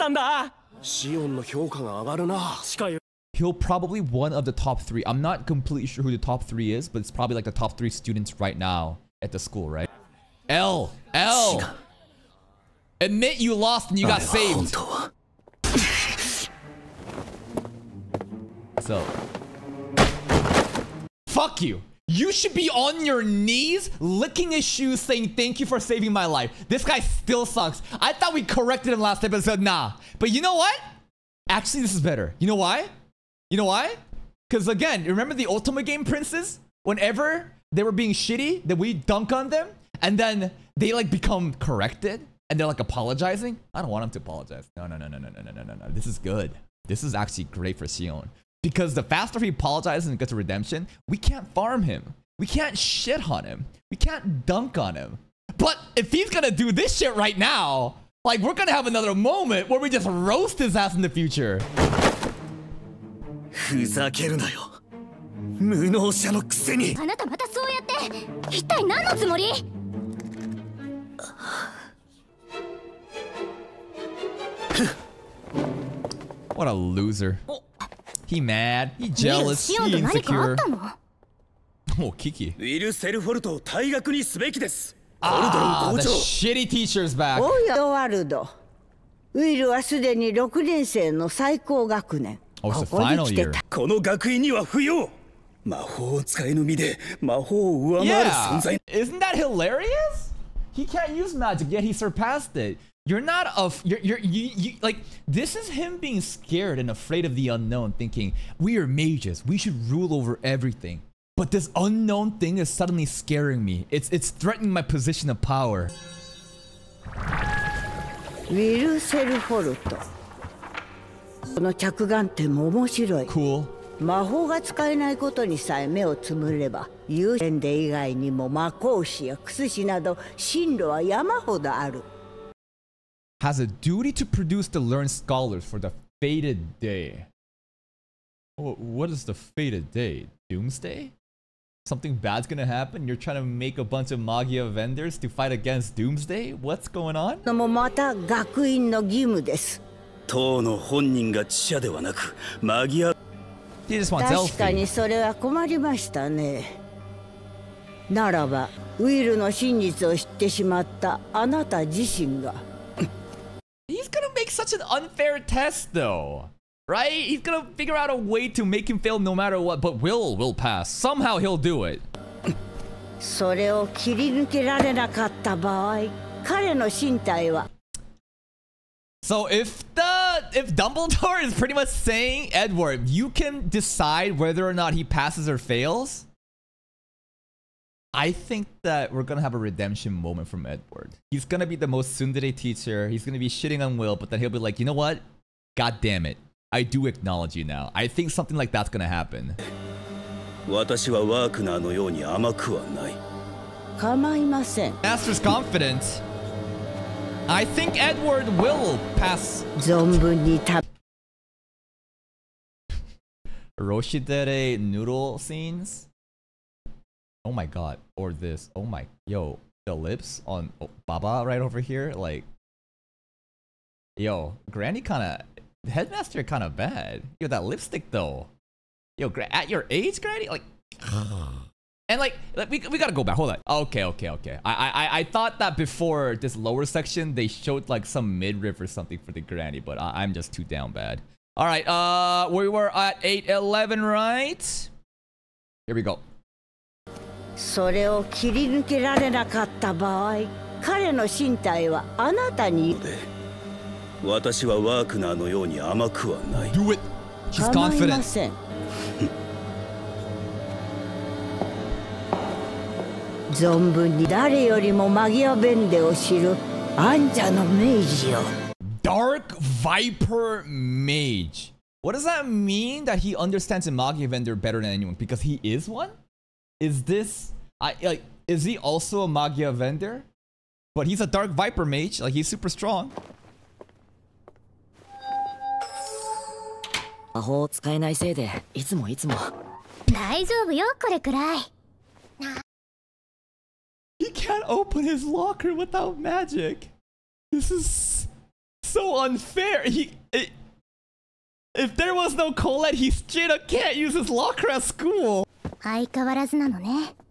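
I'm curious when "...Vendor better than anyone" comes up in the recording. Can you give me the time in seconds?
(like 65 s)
274 s.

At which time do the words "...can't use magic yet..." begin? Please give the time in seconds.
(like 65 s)
100 s.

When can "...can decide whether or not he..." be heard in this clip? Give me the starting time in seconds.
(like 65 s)
183 s.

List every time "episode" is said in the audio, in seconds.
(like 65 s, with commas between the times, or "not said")
29 s.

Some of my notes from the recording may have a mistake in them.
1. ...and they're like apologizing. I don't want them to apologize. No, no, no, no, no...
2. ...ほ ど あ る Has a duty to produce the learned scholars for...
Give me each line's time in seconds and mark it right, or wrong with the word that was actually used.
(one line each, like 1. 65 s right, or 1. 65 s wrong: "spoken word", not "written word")
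1. 42 s right
2. 131 s right.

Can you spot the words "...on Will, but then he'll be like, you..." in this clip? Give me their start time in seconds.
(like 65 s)
193 s.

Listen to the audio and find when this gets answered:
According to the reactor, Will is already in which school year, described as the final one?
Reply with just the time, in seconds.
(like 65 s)
90 s.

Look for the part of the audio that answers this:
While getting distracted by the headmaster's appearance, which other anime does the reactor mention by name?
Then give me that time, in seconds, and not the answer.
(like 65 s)
213 s.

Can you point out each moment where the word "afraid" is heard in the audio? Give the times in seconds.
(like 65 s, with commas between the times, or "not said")
106 s.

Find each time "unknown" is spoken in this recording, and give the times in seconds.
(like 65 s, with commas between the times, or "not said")
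107 s, 111 s.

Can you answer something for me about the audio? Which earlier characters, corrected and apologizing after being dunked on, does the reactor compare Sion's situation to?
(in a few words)
Ultimate Game Princes.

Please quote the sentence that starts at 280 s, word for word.
But he's a Dark Viper Mage, like he's super strong.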